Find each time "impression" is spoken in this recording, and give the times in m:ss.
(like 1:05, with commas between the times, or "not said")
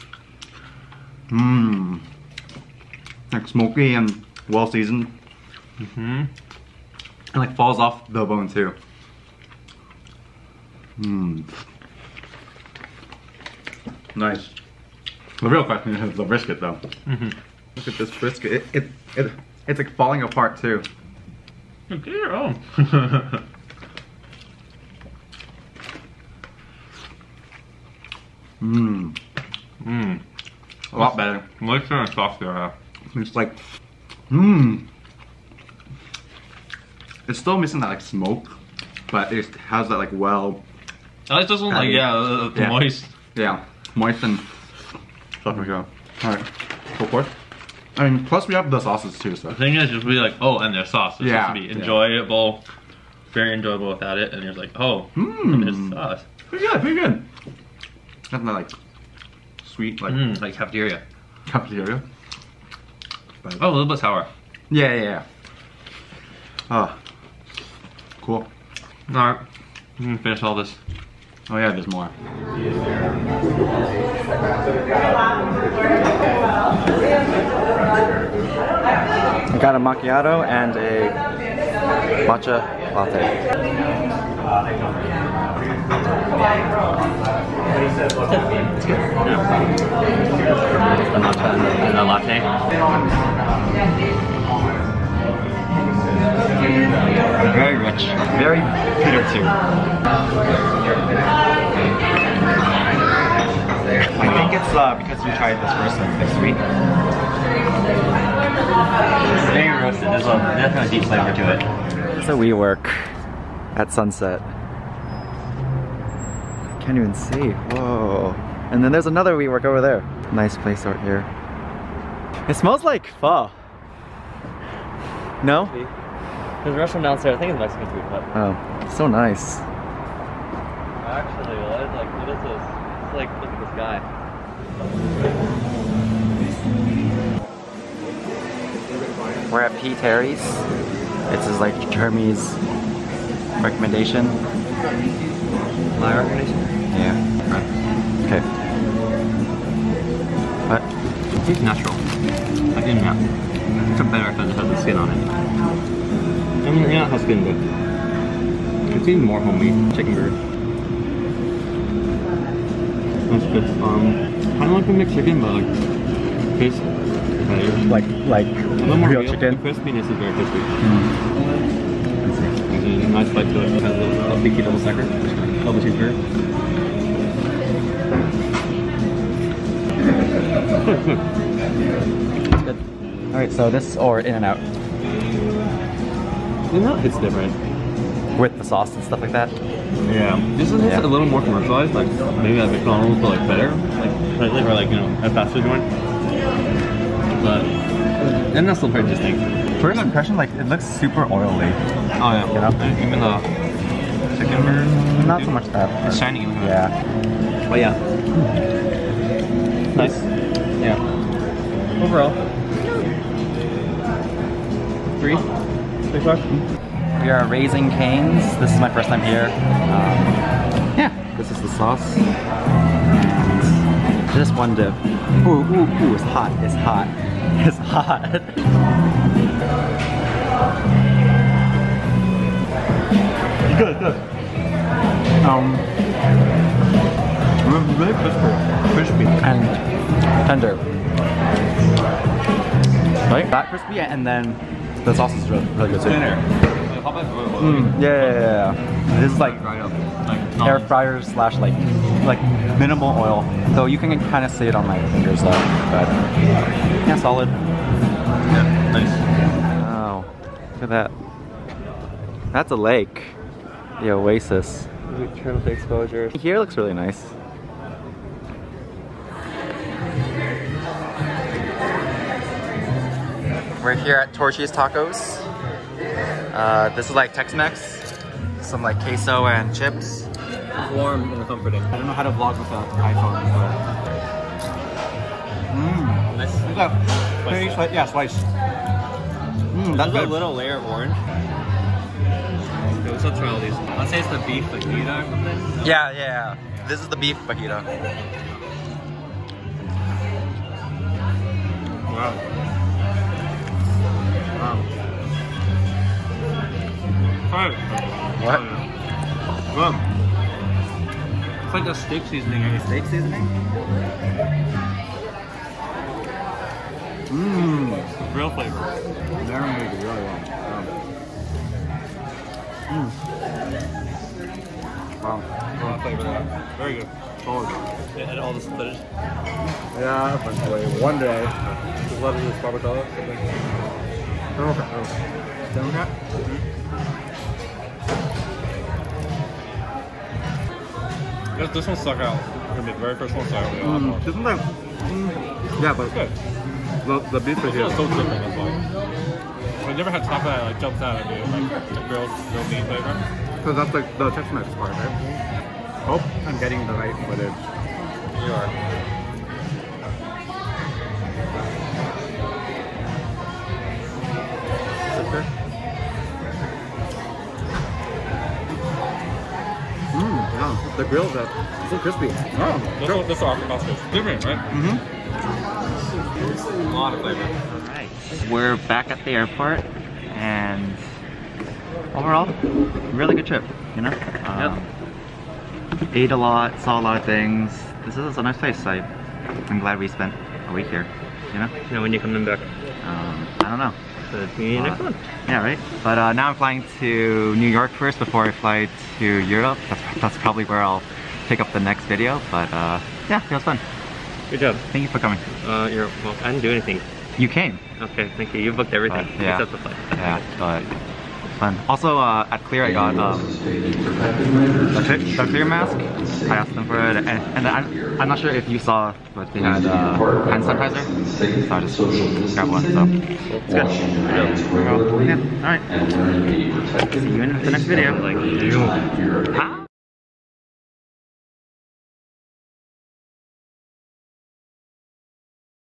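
3:19.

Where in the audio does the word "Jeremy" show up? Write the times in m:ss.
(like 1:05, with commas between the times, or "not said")
2:21.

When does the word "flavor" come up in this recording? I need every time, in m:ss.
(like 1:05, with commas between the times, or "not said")
1:51, 5:18, 5:26, 5:52, 6:17.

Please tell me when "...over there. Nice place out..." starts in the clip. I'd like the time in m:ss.
1:59.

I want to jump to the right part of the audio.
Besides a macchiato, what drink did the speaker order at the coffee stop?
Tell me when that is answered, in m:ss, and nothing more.
1:22.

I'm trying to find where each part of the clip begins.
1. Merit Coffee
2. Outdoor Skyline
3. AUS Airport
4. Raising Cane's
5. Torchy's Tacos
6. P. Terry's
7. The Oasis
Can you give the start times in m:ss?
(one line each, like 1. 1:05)
1. 1:11
2. 1:51
3. 6:16
4. 3:35
5. 4:28
6. 2:13
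7. 4:18.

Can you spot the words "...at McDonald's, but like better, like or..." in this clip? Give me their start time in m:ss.
3:12.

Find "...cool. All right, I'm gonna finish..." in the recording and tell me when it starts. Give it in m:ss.
1:08.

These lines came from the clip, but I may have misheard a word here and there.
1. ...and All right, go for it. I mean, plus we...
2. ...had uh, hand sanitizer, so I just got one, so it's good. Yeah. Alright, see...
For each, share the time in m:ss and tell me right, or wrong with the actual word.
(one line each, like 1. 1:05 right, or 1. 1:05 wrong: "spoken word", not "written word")
1. 0:44 right
2. 6:59 right.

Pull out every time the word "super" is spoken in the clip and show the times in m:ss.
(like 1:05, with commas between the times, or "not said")
3:20.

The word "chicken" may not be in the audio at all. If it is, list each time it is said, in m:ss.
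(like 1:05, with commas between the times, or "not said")
2:39, 2:45, 2:49, 3:24.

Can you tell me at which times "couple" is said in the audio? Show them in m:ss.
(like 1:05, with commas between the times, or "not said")
not said.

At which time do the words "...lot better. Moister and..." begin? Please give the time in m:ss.
0:30.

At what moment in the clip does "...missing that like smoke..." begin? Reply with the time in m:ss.
0:37.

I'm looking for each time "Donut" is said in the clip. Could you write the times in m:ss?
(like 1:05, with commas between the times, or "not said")
5:35.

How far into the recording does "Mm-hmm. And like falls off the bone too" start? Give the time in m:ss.
0:05.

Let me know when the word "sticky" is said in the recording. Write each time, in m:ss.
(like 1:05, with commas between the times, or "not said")
2:54.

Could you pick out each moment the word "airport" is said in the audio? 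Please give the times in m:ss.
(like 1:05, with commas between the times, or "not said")
6:19.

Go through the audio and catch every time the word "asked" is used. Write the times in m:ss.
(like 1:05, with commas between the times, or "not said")
6:56.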